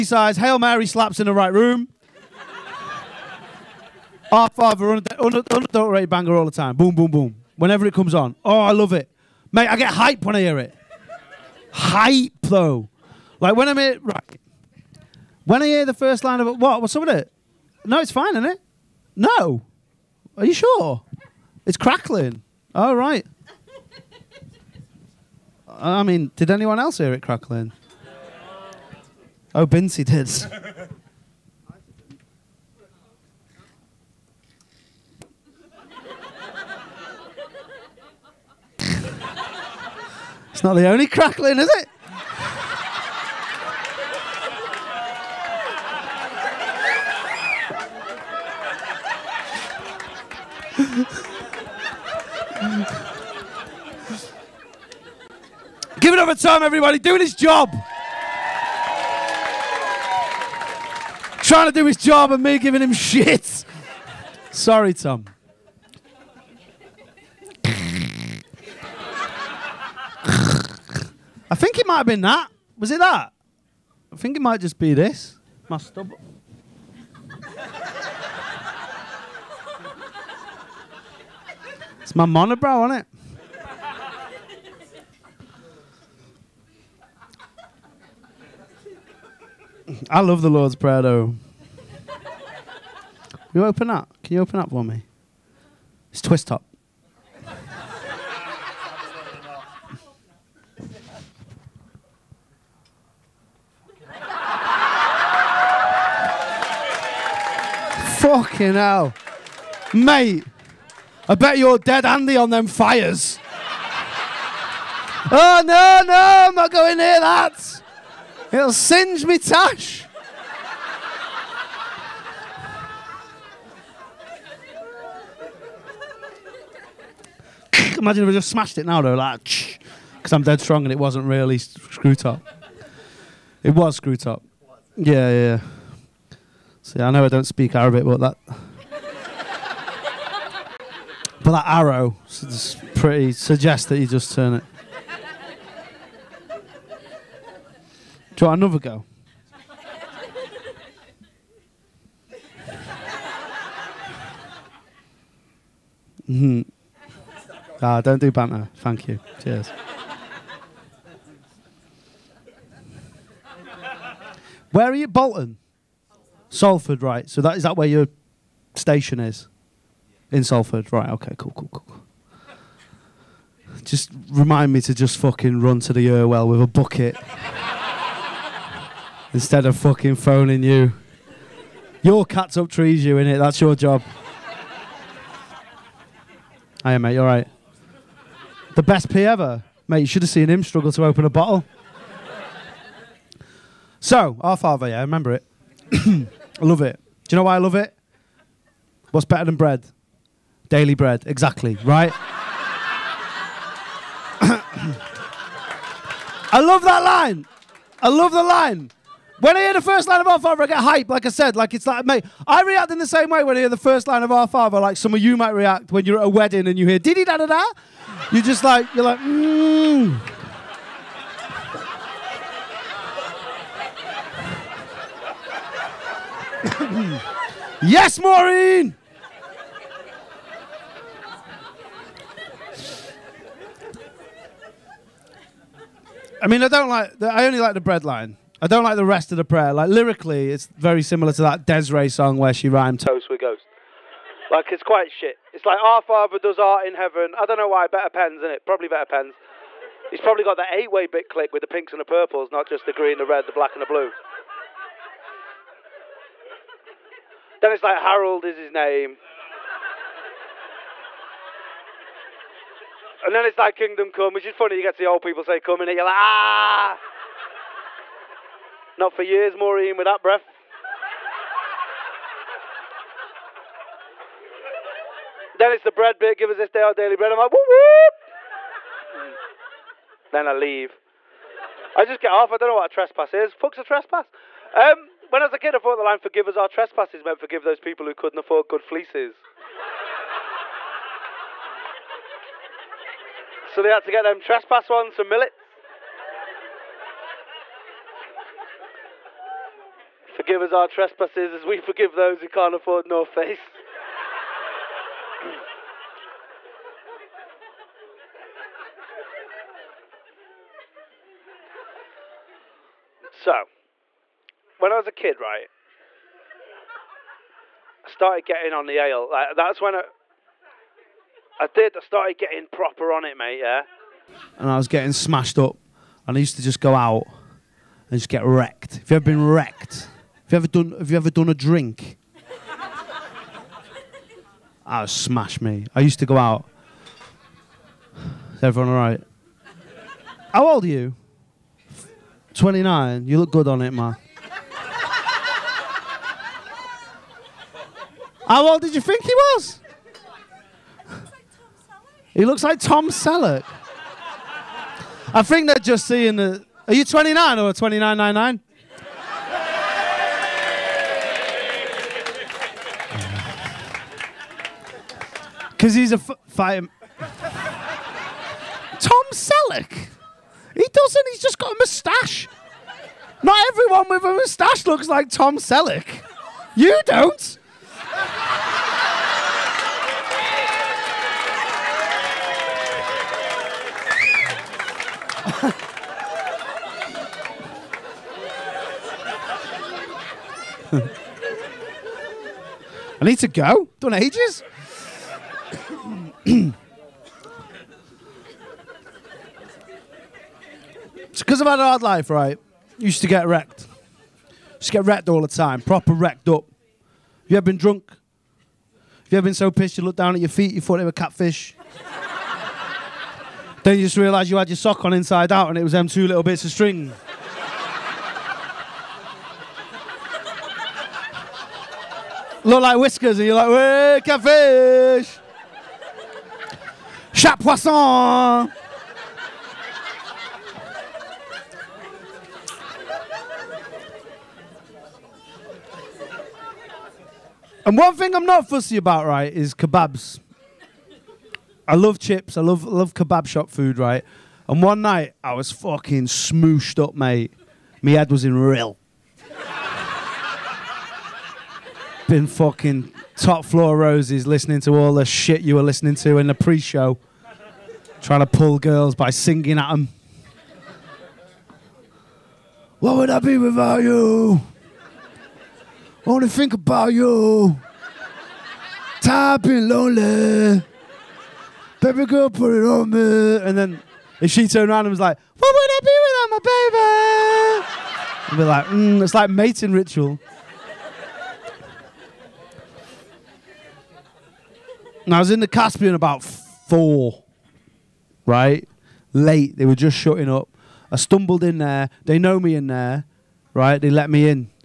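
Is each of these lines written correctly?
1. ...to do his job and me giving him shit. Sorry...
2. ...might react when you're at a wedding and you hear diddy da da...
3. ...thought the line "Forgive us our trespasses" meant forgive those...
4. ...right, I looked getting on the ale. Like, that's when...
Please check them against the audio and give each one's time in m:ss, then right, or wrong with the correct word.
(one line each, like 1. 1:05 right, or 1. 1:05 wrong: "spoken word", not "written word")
1. 1:01 right
2. 3:35 right
3. 4:45 right
4. 5:15 wrong: "started", not "looked".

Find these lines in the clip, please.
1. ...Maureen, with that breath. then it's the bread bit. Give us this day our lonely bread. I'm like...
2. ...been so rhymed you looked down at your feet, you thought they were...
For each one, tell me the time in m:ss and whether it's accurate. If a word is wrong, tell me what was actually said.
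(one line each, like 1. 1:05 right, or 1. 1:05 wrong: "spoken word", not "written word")
1. 4:29 wrong: "daily", not "lonely"
2. 6:49 wrong: "pissed", not "rhymed".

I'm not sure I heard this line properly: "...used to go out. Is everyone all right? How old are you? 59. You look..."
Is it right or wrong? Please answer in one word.
wrong.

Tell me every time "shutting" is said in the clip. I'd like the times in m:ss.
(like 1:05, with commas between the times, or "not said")
8:10.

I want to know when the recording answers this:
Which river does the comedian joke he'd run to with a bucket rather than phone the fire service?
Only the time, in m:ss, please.
2:56.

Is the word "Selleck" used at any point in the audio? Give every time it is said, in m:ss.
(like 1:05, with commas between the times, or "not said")
5:53, 6:09, 6:15.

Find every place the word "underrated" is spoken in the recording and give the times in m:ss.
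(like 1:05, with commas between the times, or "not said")
0:05.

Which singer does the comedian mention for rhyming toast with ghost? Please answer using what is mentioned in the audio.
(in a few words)
Des'ree.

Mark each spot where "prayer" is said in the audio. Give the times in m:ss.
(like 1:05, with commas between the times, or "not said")
1:30, 3:59.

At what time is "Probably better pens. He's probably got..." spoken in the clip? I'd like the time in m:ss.
4:08.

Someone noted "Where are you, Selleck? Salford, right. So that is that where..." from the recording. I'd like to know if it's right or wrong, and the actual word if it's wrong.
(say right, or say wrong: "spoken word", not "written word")
wrong: "Bolton", not "Selleck".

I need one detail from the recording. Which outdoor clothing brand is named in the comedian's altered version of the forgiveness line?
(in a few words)
North Face.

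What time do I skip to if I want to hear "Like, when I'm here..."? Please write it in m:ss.
0:13.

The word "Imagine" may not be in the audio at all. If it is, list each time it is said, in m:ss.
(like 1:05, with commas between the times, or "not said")
2:07.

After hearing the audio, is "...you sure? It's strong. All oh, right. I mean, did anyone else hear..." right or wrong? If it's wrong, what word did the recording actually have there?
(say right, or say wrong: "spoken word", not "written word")
wrong: "crackling", not "strong".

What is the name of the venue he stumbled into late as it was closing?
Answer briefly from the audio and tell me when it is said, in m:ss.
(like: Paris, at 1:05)
The Caspian, at 8:05.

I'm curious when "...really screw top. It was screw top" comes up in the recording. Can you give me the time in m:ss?
2:11.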